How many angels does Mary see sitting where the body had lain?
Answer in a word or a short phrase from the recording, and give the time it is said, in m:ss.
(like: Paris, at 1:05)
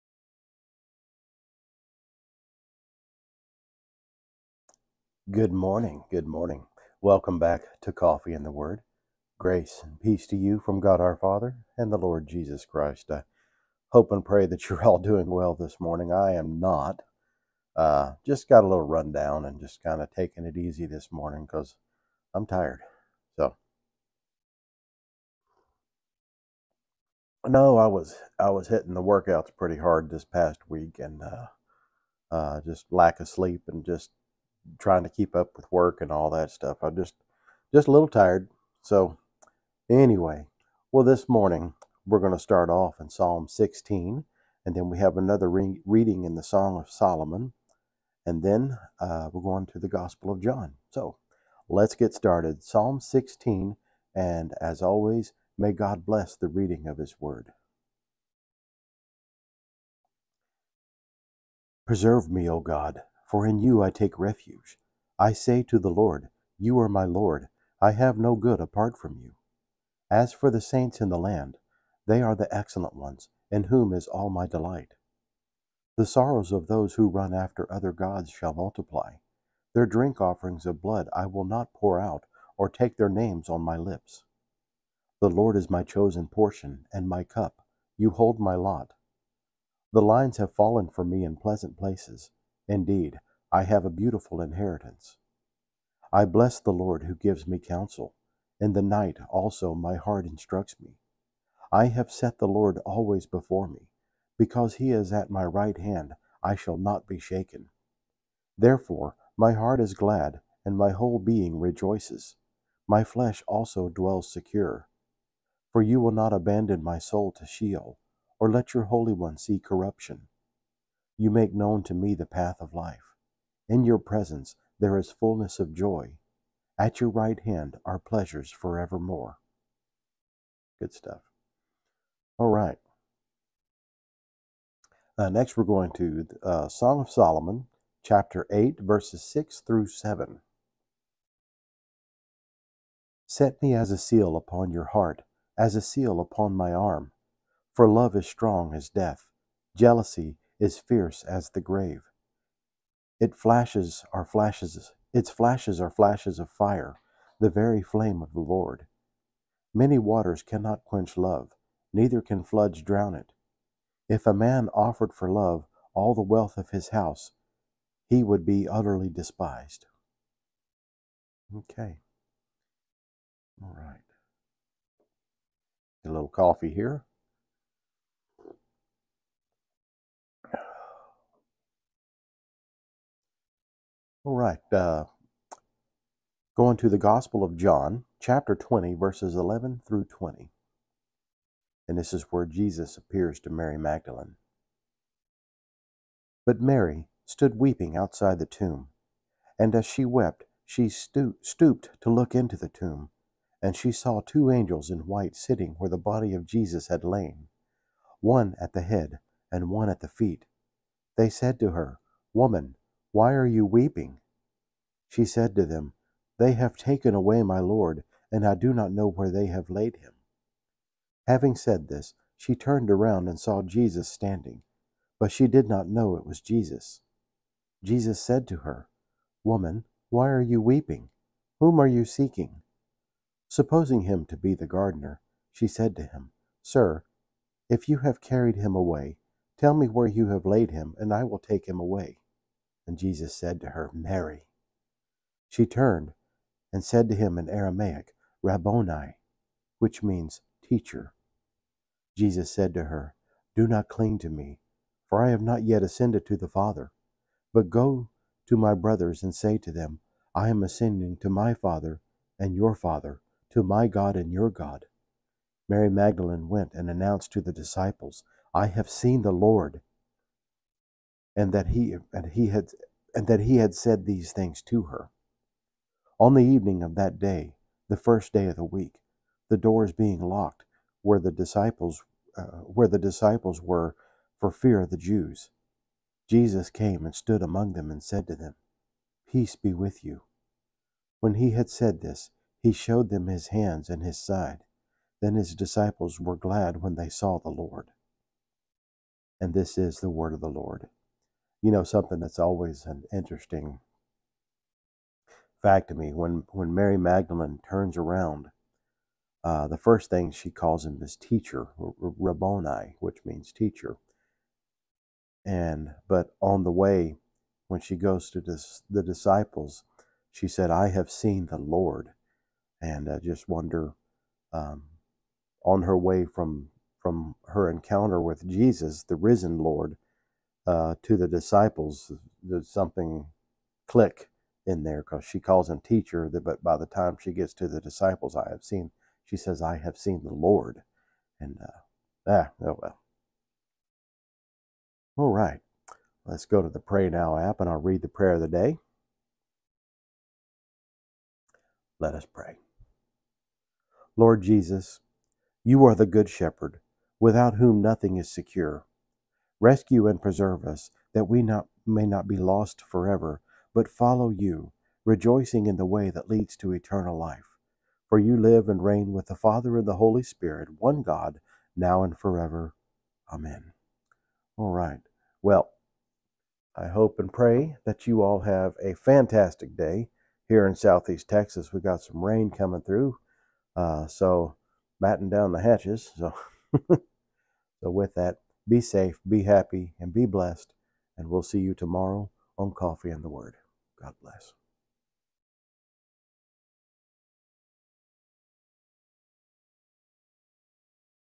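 2, at 3:24.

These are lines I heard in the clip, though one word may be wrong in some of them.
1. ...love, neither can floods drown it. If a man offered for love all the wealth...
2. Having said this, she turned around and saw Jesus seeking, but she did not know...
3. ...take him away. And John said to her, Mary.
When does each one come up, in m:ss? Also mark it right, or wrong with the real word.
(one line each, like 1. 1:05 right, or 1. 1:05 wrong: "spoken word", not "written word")
1. 2:41 right
2. 3:41 wrong: "standing", not "seeking"
3. 4:01 wrong: "Jesus", not "John".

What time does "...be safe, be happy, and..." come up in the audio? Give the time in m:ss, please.
6:28.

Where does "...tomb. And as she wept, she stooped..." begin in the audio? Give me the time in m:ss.
3:18.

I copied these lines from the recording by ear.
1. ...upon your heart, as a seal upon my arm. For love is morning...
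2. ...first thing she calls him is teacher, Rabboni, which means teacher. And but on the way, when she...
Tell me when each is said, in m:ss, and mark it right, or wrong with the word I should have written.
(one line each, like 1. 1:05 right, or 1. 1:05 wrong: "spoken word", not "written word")
1. 2:24 wrong: "strong", not "morning"
2. 5:09 right.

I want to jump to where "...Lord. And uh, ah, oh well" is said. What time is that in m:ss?
5:40.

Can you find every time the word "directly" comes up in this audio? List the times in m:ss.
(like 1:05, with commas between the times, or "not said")
not said.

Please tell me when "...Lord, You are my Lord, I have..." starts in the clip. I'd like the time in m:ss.
1:05.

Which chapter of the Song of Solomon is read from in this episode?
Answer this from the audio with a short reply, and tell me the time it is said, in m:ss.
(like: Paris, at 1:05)
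8, at 2:18.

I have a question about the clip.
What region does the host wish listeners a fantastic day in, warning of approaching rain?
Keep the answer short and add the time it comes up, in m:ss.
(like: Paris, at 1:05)
Southeast Texas, at 6:20.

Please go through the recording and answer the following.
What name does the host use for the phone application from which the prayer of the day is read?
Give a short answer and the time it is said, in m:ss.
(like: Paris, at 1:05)
Pray Now, at 5:46.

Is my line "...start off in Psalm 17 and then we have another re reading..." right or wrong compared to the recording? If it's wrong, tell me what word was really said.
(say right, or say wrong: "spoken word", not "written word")
wrong: "16", not "17".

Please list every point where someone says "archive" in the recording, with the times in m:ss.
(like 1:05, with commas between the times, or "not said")
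not said.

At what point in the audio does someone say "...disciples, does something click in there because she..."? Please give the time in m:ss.
5:31.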